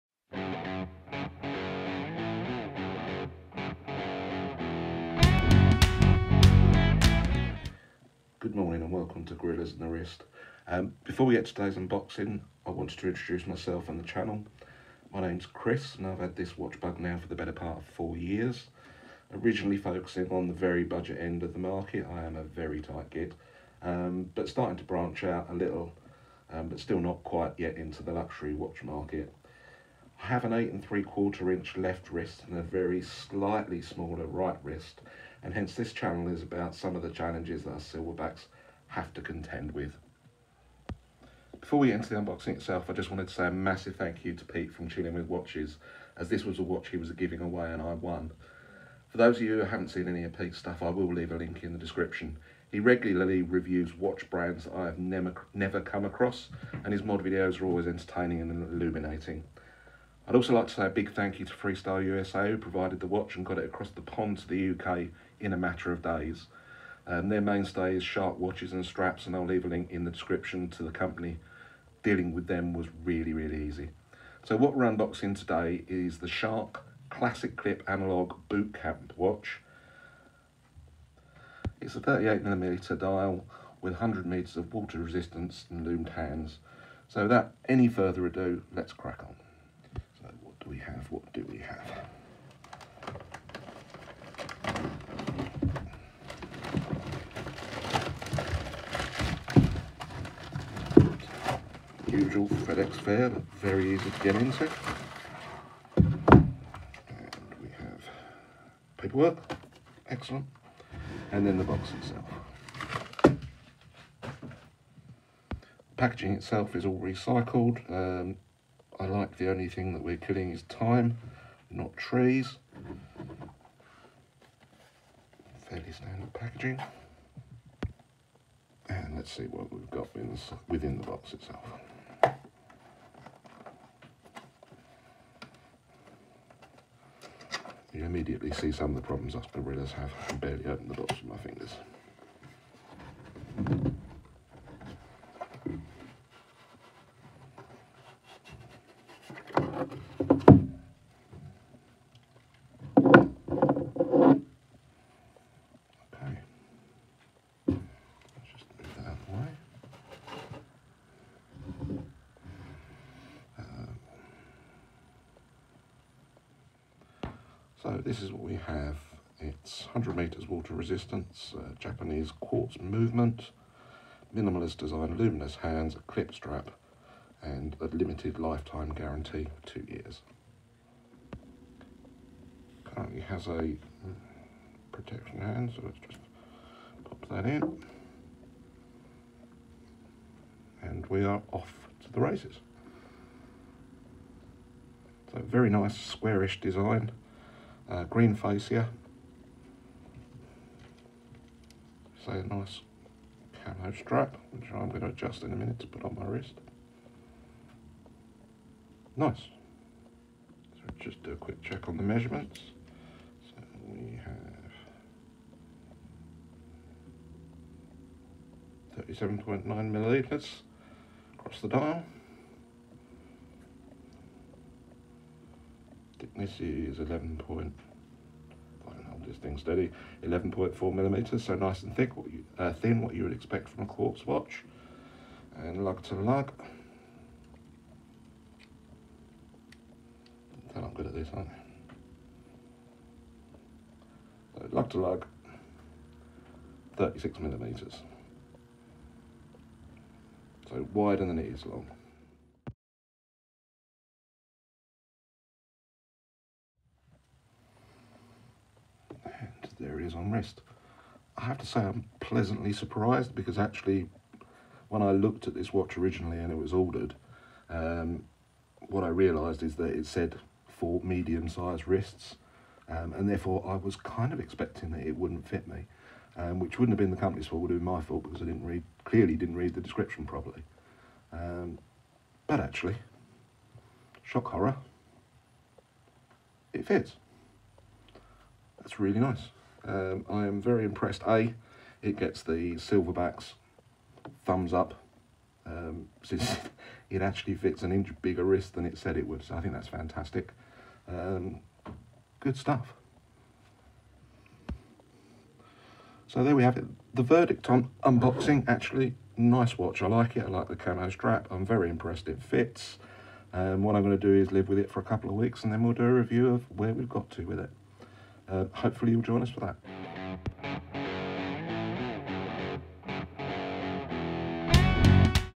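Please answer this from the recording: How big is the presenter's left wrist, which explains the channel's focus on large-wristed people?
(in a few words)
8 and 3/4 inches.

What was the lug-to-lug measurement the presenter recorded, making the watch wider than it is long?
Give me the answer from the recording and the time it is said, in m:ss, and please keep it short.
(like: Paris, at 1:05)
36 mm, at 4:06.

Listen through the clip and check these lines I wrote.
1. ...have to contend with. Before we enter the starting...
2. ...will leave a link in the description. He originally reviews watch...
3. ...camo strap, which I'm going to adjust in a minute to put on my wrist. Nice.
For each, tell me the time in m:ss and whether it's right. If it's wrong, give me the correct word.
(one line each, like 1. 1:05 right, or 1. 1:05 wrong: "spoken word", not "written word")
1. 0:38 wrong: "unboxing", not "starting"
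2. 0:50 wrong: "regularly", not "originally"
3. 3:23 right.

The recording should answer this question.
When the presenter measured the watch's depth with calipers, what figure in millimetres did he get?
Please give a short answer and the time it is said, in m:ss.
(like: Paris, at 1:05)
11.4 mm, at 3:50.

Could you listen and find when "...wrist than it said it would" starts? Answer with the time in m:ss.
4:58.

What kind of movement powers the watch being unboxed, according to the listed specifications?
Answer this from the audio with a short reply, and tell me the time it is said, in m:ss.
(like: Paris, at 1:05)
Japanese quartz, at 2:51.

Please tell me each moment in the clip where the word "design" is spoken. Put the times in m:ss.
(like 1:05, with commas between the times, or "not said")
2:54, 3:16.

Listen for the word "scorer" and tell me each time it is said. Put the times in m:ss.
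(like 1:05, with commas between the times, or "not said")
not said.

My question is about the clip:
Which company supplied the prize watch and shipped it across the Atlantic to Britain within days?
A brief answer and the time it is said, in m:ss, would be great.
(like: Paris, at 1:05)
Freestyle USA, at 1:01.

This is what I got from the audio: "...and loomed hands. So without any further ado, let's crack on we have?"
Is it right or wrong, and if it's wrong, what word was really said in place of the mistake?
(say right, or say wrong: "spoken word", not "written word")
right.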